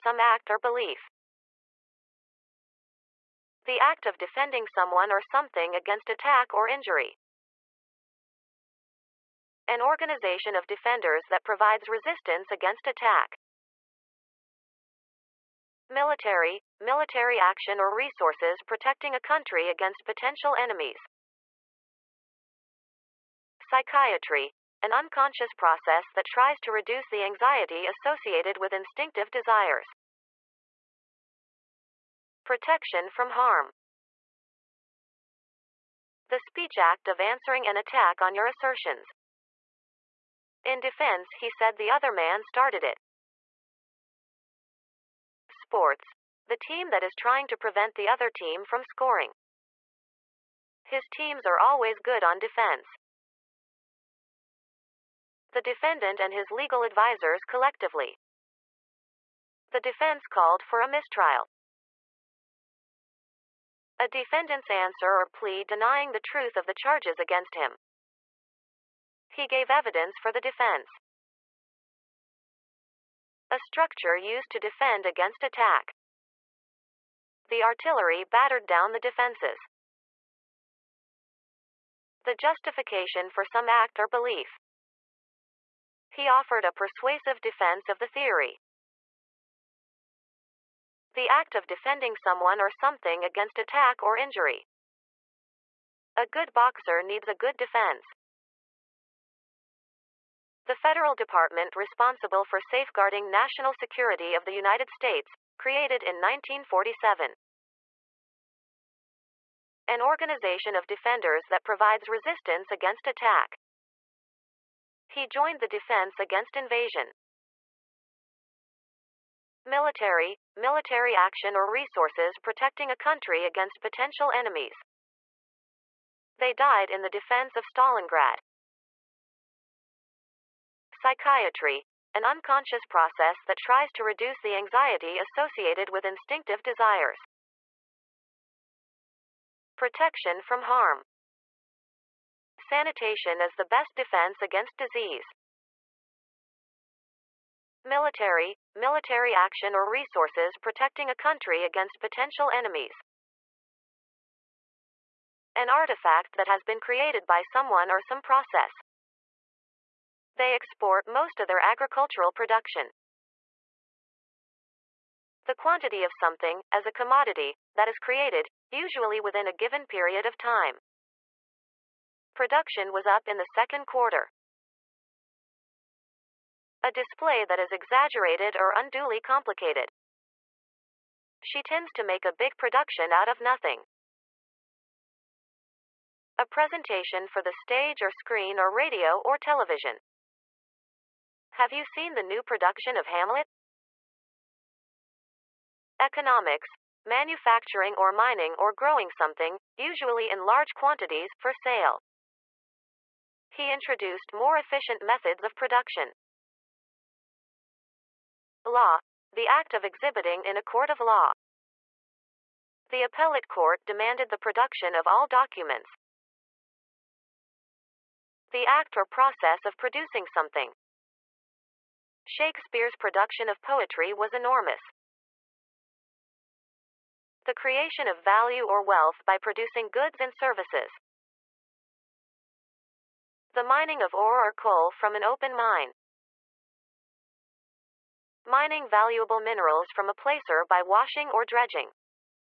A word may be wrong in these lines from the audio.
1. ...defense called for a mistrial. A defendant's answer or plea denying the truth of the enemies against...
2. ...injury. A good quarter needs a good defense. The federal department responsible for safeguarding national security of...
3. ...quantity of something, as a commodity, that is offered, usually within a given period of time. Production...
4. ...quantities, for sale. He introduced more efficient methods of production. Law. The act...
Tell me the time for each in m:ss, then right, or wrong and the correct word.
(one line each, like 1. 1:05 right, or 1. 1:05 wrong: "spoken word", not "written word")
1. 0:59 wrong: "charges", not "enemies"
2. 1:34 wrong: "boxer", not "quarter"
3. 2:45 wrong: "created", not "offered"
4. 3:20 right.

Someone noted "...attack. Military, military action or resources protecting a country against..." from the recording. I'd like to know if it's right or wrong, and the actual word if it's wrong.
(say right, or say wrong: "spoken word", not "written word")
right.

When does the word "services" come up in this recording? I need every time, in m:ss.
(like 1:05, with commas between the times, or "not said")
3:50.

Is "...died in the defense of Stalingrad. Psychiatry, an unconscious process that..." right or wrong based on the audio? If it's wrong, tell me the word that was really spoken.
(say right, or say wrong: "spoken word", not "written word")
right.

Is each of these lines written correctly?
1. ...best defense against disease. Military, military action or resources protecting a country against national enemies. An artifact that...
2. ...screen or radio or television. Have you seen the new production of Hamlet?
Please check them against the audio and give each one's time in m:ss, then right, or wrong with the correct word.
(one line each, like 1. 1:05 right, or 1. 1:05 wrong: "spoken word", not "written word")
1. 2:23 wrong: "potential", not "national"
2. 3:08 right.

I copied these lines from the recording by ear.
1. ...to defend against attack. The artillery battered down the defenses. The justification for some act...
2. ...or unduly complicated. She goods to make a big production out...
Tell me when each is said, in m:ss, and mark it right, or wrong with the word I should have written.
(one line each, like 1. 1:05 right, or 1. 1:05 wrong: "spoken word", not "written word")
1. 1:14 right
2. 2:58 wrong: "tends", not "goods".